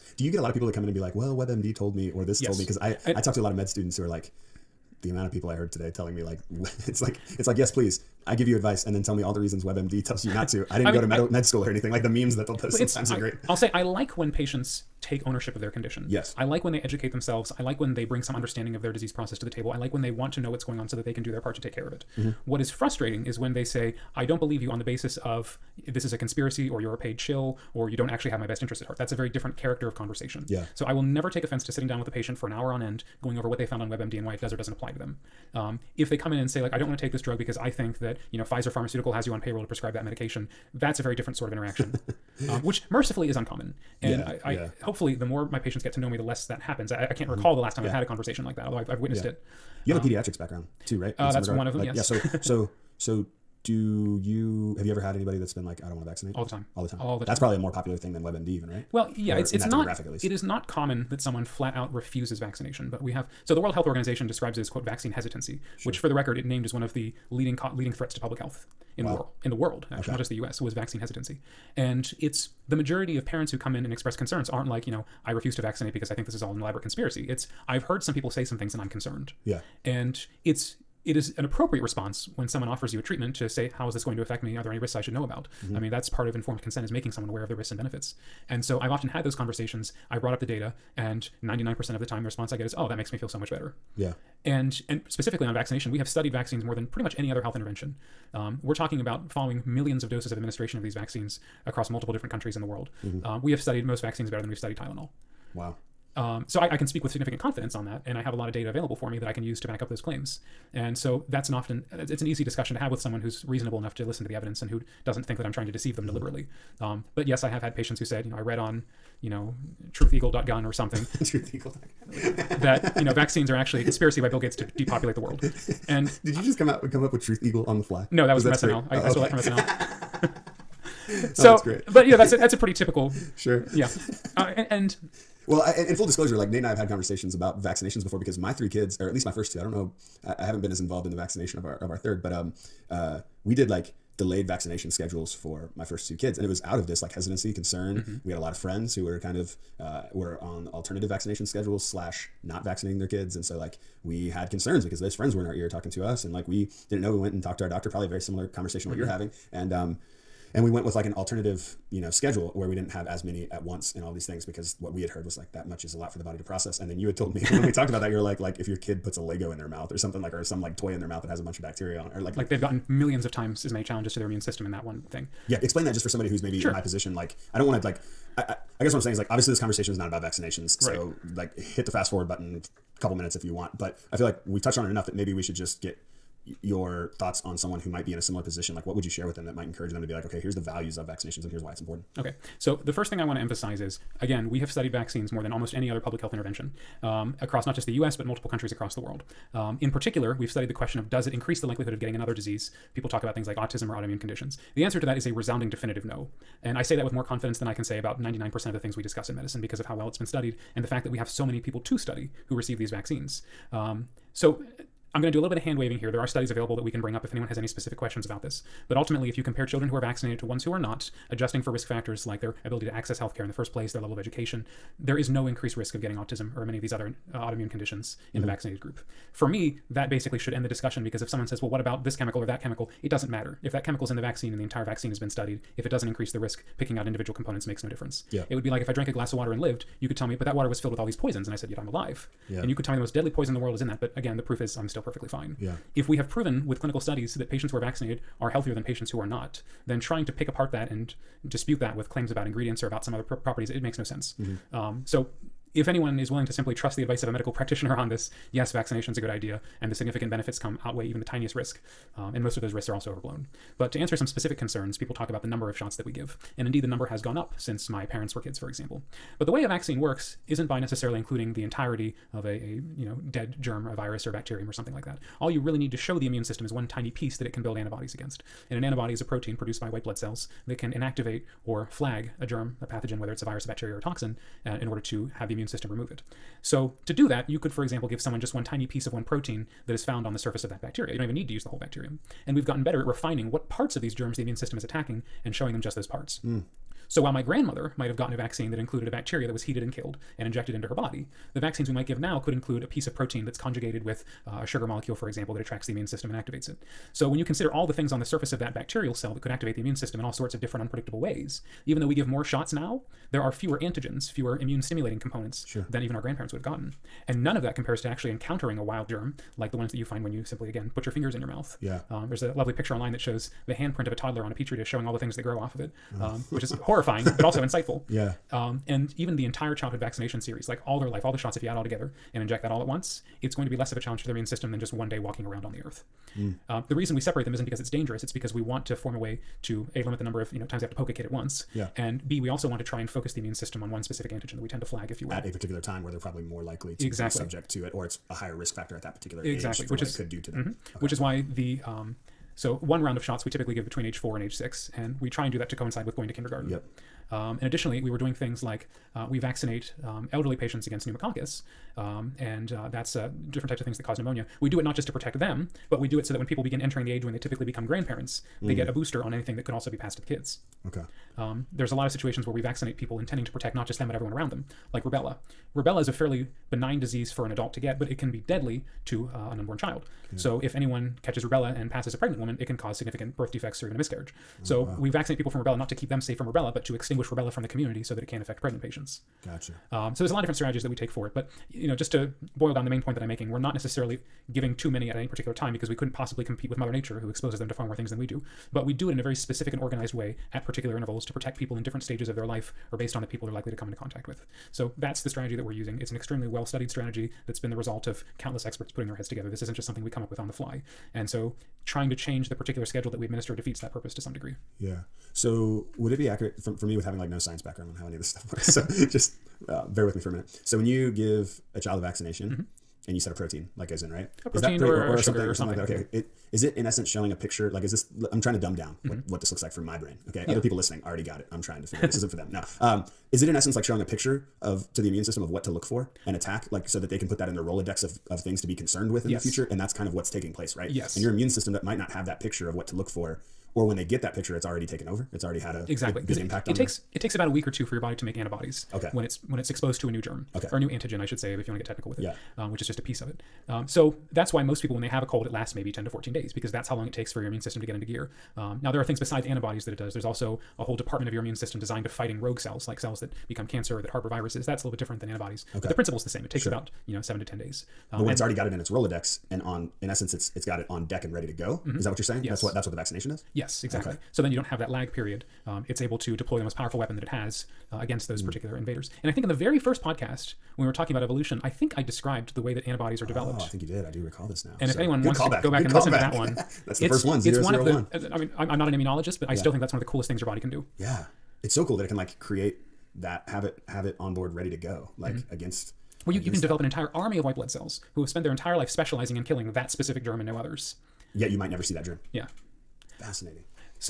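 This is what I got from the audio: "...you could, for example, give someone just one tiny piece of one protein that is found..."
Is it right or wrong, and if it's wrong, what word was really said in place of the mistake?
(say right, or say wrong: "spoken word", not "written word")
right.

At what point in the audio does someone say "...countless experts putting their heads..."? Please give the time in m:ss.
6:48.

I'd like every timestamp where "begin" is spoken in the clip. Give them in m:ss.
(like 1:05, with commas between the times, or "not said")
6:06.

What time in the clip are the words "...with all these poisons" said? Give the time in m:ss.
4:00.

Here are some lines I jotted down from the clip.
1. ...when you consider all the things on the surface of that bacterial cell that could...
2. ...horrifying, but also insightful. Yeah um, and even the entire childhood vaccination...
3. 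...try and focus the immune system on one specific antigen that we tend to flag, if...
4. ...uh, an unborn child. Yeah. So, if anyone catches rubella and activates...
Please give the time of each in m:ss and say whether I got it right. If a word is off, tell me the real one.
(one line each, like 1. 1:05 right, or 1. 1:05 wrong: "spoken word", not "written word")
1. 5:07 right
2. 5:26 right
3. 5:42 right
4. 6:19 wrong: "passes", not "activates".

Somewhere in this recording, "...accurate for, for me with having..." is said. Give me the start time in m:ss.
6:56.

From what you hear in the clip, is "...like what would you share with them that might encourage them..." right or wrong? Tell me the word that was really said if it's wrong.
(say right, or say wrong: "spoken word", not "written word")
right.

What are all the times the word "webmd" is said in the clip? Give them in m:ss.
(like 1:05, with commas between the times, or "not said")
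0:01, 0:09, 0:33, 0:58.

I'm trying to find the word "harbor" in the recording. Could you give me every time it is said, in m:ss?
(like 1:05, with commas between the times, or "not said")
7:44.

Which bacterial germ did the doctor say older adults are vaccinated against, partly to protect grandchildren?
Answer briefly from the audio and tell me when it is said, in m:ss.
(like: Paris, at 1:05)
Pneumococcus, at 6:01.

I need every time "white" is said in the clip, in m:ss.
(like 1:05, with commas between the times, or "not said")
4:39, 8:17.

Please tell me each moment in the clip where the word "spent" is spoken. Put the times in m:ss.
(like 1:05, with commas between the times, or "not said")
8:18.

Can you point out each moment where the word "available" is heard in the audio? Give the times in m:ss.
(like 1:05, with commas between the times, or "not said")
1:48, 3:36.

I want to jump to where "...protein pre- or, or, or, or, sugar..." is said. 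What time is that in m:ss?
7:04.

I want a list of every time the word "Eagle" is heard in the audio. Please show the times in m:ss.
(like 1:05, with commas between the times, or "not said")
2:01, 2:07.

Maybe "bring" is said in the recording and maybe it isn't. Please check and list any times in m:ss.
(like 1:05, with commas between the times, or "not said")
0:18, 3:37.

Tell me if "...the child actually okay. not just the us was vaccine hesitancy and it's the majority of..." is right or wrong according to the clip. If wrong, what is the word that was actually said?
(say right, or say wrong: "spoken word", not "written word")
wrong: "world", not "child".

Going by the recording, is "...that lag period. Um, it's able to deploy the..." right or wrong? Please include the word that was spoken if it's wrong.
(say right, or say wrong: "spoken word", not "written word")
right.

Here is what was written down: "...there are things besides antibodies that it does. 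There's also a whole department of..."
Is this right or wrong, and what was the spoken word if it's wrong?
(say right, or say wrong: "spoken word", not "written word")
right.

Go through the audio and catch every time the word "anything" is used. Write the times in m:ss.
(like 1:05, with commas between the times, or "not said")
0:11, 6:09.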